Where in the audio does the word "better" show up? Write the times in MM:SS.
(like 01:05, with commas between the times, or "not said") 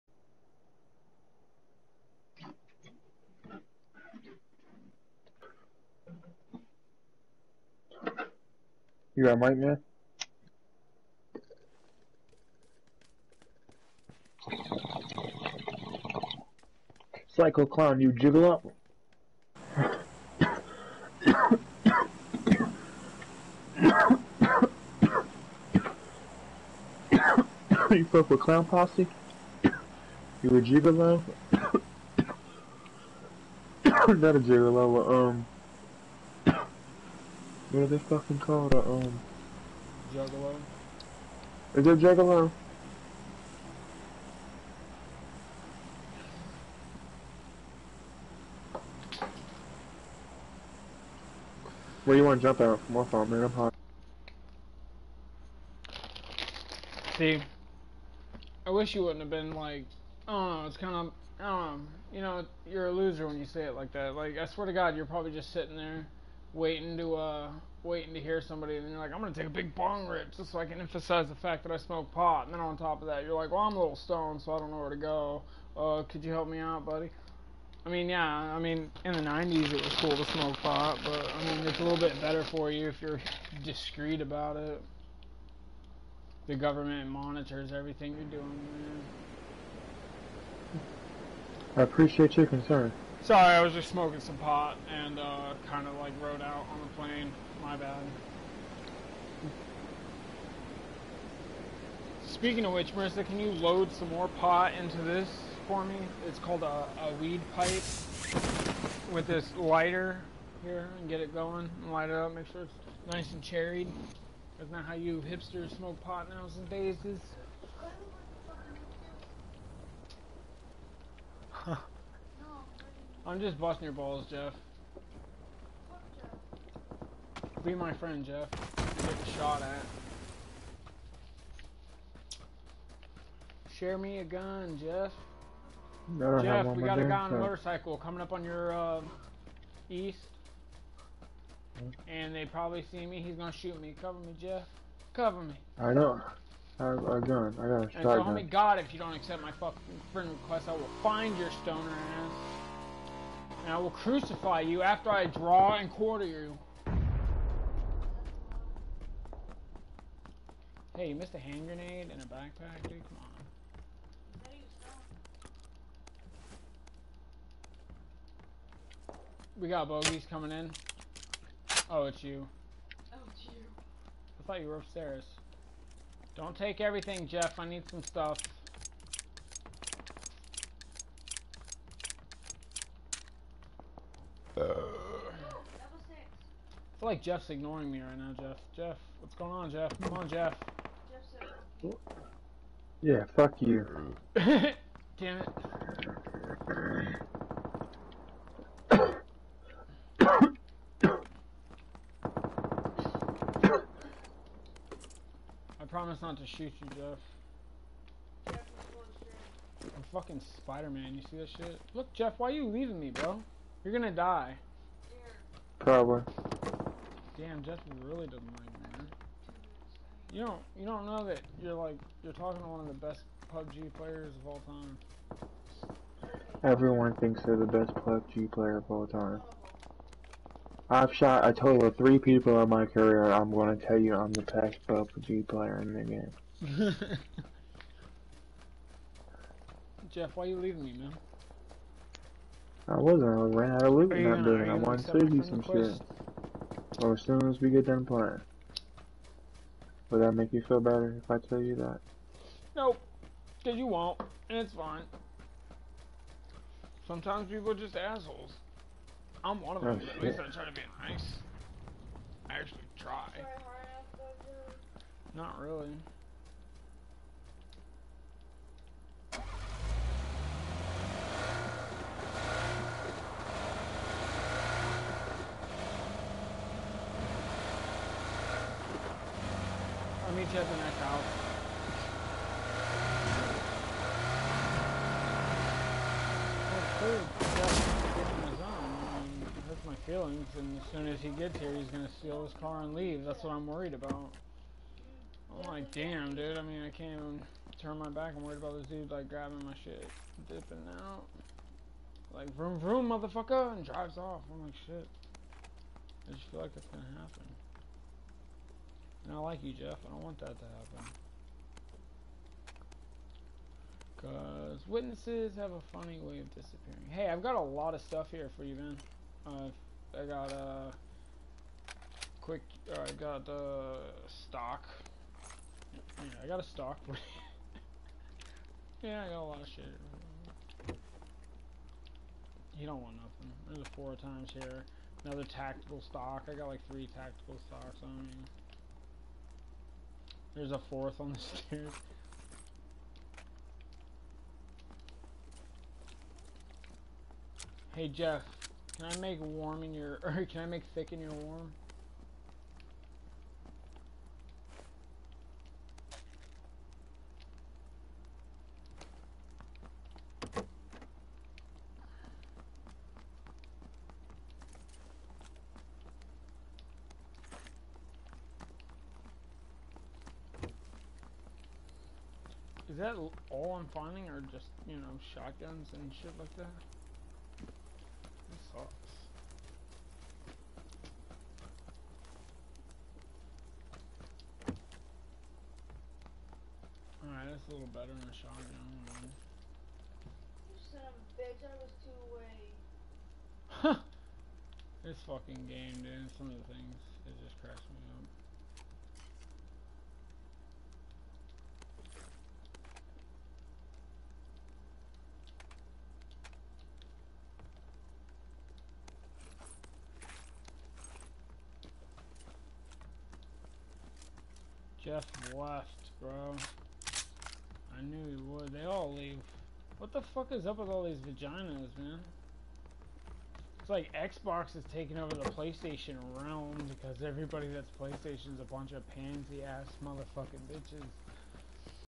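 01:22, 04:10, 06:27.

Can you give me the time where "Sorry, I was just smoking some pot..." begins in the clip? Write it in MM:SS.
01:33.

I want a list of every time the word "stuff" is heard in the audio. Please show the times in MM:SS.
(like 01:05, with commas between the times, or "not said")
02:58, 05:18.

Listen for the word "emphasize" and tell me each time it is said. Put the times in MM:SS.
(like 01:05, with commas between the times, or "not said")
01:10.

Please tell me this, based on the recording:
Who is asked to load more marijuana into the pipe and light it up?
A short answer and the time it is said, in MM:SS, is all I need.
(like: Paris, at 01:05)
Marissa, at 01:42.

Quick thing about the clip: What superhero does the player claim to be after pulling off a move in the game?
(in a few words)
Spider-Man.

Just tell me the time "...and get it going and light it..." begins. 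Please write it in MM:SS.
01:50.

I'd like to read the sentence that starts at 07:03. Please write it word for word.
It's like Xbox is taking over the PlayStation realm because everybody that's PlayStation is a bunch of pansy ass motherfucking bitches.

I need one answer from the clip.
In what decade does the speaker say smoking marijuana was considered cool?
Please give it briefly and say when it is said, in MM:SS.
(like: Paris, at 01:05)
the 90s, at 01:19.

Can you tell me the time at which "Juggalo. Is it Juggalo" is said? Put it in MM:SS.
00:40.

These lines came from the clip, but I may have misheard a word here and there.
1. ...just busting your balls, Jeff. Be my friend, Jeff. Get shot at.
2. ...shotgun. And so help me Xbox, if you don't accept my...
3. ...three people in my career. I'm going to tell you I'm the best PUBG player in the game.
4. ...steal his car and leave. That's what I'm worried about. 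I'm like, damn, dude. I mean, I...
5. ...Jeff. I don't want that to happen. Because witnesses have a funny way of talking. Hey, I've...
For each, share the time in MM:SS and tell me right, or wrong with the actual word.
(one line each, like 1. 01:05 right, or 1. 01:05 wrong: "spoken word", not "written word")
1. 02:03 right
2. 02:27 wrong: "God", not "Xbox"
3. 03:51 right
4. 04:52 right
5. 05:09 wrong: "disappearing", not "talking".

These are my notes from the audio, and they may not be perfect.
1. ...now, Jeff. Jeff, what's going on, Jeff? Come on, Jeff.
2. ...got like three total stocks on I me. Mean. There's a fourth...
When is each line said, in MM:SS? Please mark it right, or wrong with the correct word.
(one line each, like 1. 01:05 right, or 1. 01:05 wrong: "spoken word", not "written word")
1. 03:08 right
2. 05:36 wrong: "tactical", not "total".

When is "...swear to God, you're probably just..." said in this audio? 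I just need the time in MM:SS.
01:04.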